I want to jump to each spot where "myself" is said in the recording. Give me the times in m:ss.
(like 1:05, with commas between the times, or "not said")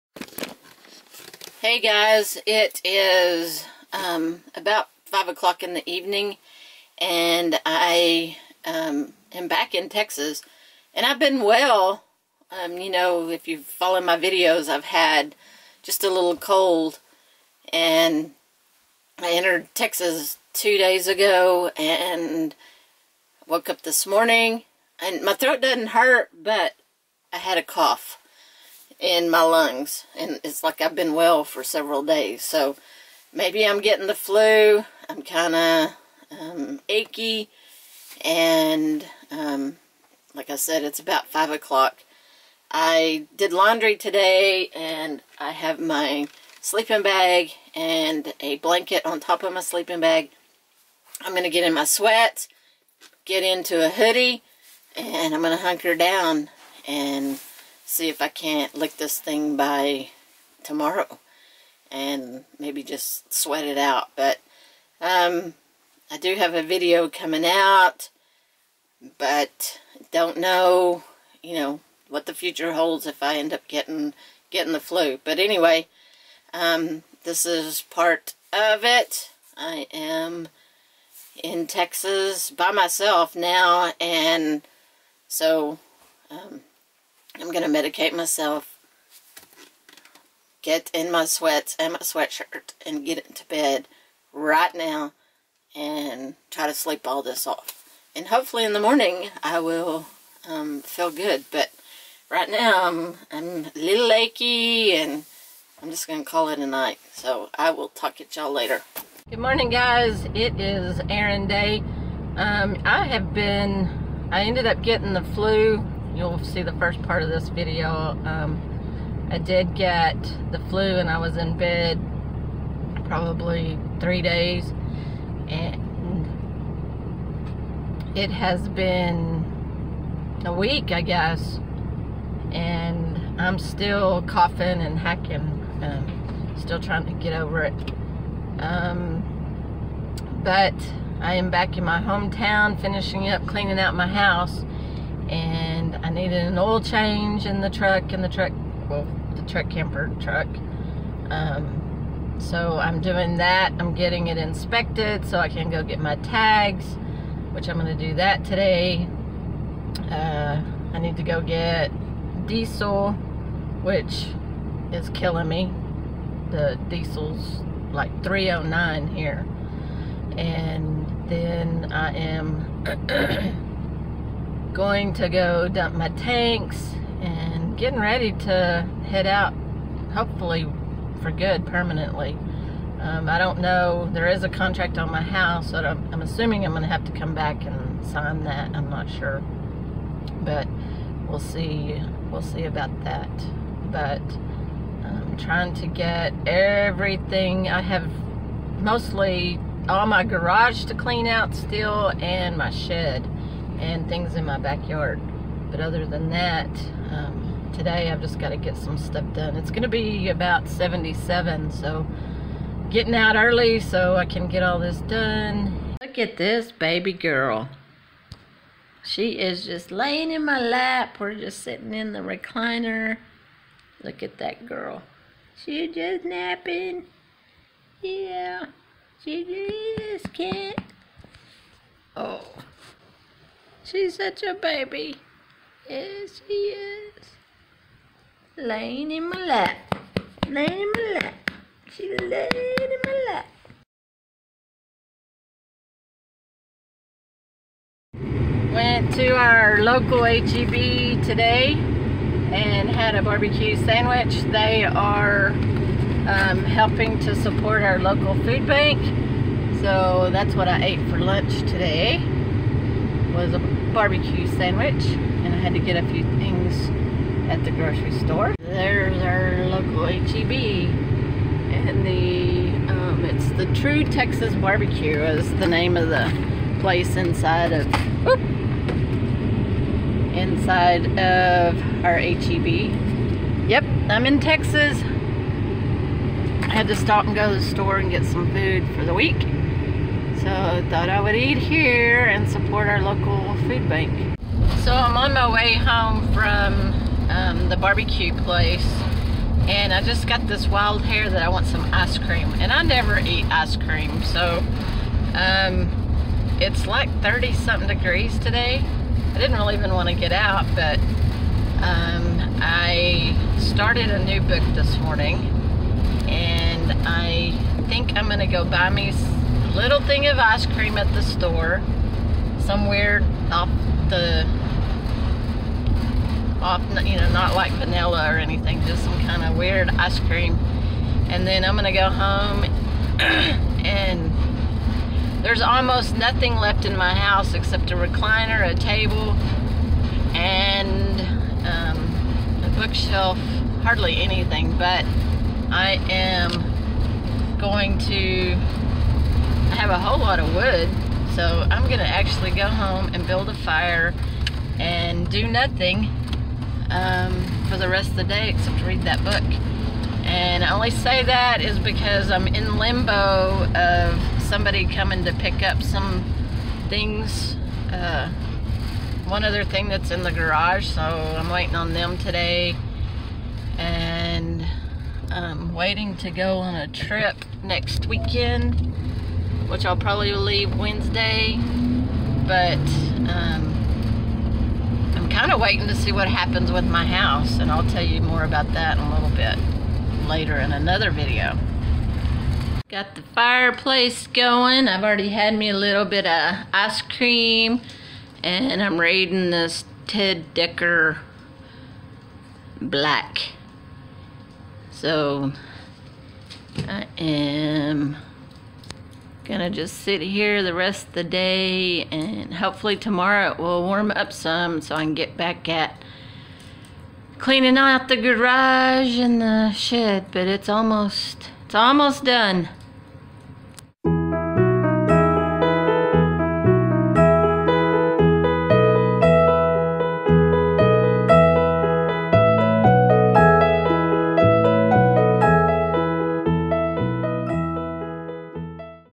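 1:22, 1:28.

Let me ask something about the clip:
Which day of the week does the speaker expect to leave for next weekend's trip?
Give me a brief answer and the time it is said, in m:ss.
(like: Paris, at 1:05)
Wednesday, at 6:20.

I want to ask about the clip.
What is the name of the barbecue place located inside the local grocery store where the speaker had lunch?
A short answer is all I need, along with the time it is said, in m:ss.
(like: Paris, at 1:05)
True Texas Barbecue, at 4:33.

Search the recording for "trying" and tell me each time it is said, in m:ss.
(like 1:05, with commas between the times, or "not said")
2:16, 3:15.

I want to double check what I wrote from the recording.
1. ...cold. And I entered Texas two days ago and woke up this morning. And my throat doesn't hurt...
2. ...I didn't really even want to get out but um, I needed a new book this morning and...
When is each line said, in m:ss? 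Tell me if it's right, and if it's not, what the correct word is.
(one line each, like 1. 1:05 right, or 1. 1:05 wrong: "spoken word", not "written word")
1. 0:16 right
2. 5:09 wrong: "started", not "needed".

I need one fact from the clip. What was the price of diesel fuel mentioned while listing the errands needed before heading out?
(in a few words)
3.09.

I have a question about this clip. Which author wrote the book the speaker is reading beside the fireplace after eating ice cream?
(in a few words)
Ted Dekker.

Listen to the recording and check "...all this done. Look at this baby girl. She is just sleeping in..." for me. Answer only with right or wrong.
wrong.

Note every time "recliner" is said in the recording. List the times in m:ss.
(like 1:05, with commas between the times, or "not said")
3:42, 5:37.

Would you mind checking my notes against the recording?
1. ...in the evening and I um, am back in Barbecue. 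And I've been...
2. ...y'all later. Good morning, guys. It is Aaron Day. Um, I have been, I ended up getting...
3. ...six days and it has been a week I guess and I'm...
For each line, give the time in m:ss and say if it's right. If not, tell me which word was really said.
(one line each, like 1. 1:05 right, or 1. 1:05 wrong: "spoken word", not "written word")
1. 0:05 wrong: "Texas", not "Barbecue"
2. 1:48 right
3. 2:03 wrong: "three", not "six".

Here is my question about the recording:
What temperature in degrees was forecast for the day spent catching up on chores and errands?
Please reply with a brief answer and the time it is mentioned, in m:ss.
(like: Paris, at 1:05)
77, at 3:30.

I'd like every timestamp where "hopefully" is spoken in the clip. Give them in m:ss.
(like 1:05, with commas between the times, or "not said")
1:38, 3:00, 6:52.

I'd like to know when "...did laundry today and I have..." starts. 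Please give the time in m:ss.
0:43.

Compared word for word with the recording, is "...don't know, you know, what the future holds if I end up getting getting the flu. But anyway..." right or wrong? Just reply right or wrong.
right.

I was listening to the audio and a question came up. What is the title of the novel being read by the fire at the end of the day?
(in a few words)
Black.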